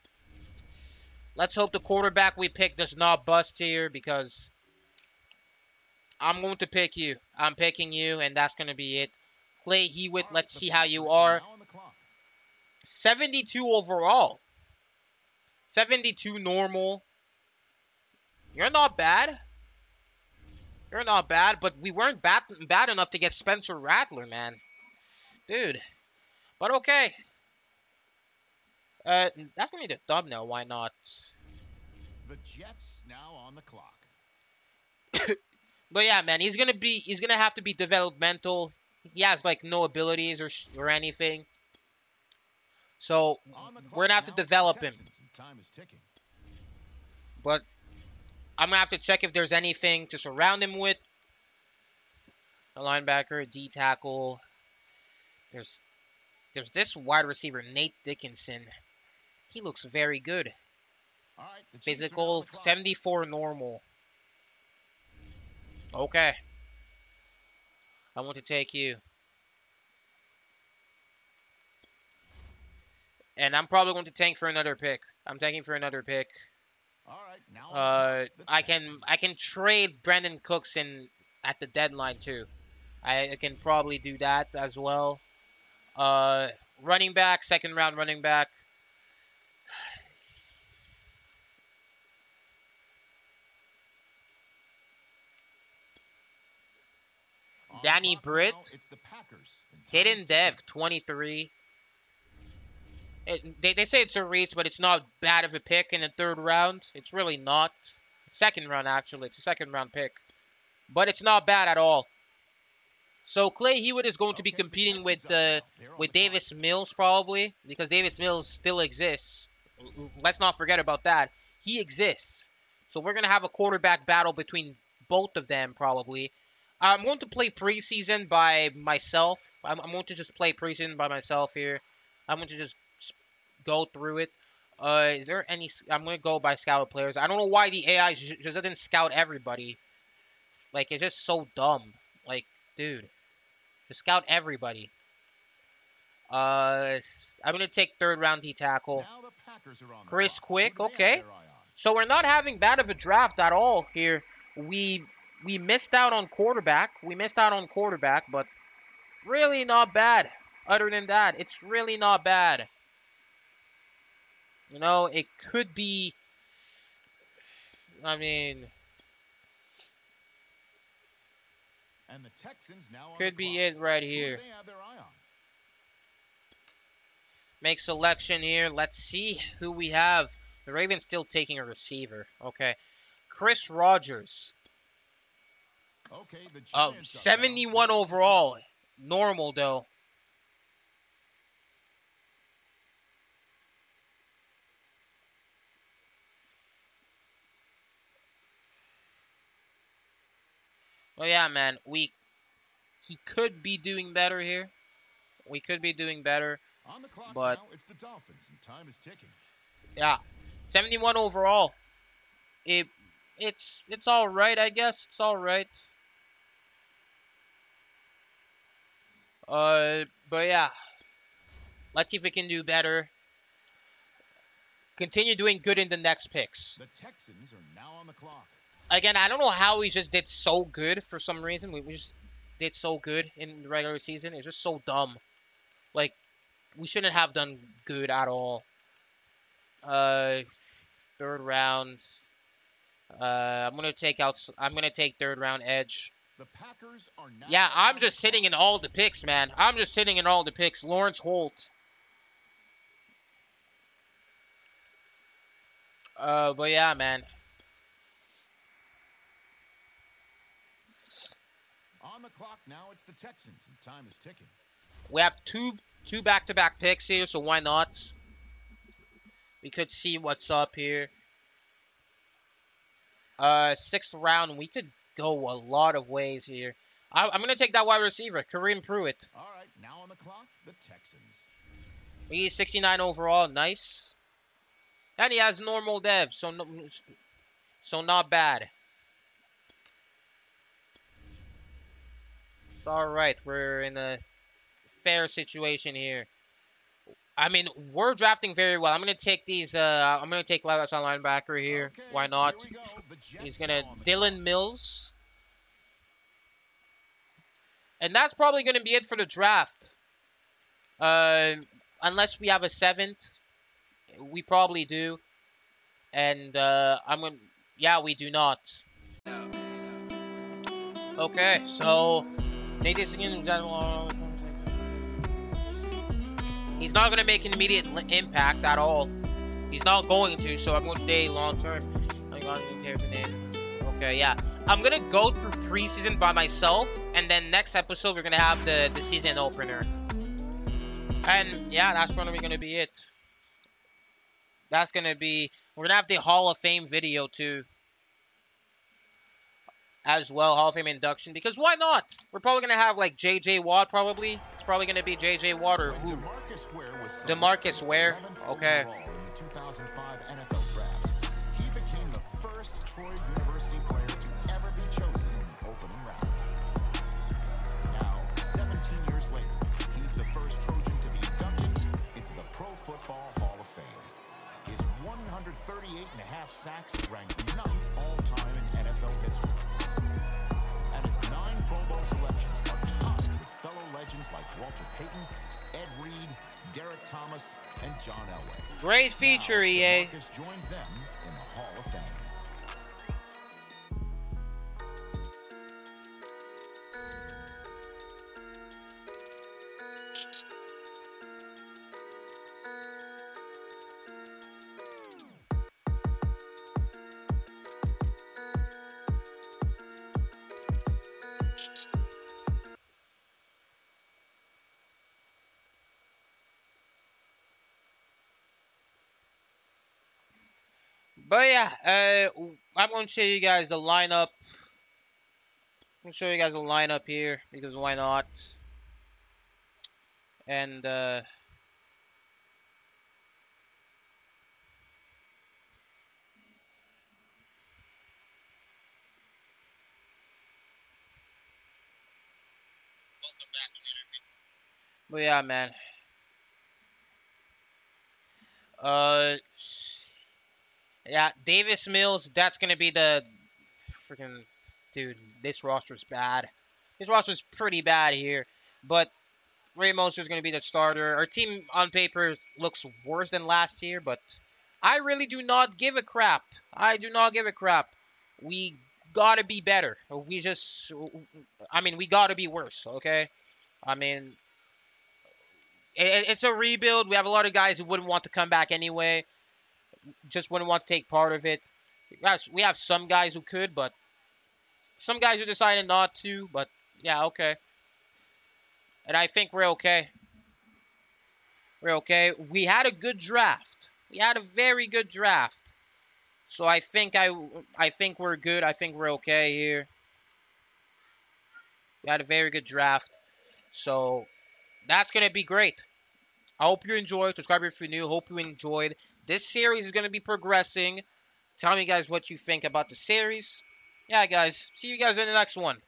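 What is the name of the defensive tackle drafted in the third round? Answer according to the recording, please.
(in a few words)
Chris Quick.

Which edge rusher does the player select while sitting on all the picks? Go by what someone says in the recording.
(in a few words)
Lawrence Holt.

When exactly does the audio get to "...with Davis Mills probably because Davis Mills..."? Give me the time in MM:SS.
01:55.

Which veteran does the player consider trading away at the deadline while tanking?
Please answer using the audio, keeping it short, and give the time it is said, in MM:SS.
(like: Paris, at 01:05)
Brandin Cooks, at 01:20.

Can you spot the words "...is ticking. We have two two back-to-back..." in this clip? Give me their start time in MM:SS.
04:24.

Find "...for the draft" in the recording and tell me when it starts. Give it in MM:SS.
05:09.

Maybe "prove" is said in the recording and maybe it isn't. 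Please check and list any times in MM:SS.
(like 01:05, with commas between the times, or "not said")
not said.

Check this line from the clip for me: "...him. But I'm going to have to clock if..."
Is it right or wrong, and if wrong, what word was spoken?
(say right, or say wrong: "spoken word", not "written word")
wrong: "check", not "clock".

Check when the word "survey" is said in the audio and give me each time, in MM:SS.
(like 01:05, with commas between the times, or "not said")
not said.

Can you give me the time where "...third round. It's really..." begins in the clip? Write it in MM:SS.
01:46.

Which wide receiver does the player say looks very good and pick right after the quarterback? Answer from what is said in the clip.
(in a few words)
Nate Dickinson.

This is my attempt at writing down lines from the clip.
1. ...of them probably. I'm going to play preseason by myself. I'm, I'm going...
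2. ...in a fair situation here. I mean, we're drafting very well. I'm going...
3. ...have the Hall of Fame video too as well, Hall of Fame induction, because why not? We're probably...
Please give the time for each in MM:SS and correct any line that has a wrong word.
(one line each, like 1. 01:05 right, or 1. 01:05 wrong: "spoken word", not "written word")
1. 02:05 right
2. 04:53 right
3. 05:45 right.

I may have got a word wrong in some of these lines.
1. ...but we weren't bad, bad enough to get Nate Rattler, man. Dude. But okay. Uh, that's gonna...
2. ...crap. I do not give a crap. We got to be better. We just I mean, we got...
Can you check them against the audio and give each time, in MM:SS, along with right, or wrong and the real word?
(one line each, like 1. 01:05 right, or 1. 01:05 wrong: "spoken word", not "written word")
1. 00:21 wrong: "Spencer", not "Nate"
2. 07:46 right.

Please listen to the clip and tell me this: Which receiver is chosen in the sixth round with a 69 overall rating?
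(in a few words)
Kareem Pruitt.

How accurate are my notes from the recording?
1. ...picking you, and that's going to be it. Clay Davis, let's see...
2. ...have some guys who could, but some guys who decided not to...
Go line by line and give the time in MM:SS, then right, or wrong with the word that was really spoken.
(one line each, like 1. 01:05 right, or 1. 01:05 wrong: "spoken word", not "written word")
1. 00:07 wrong: "Hewitt", not "Davis"
2. 08:02 right.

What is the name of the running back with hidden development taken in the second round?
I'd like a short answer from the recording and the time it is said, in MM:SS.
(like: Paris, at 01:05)
Danny Britt, at 01:37.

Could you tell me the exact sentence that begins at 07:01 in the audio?
But yeah, uh, I'm going to show you guys the lineup.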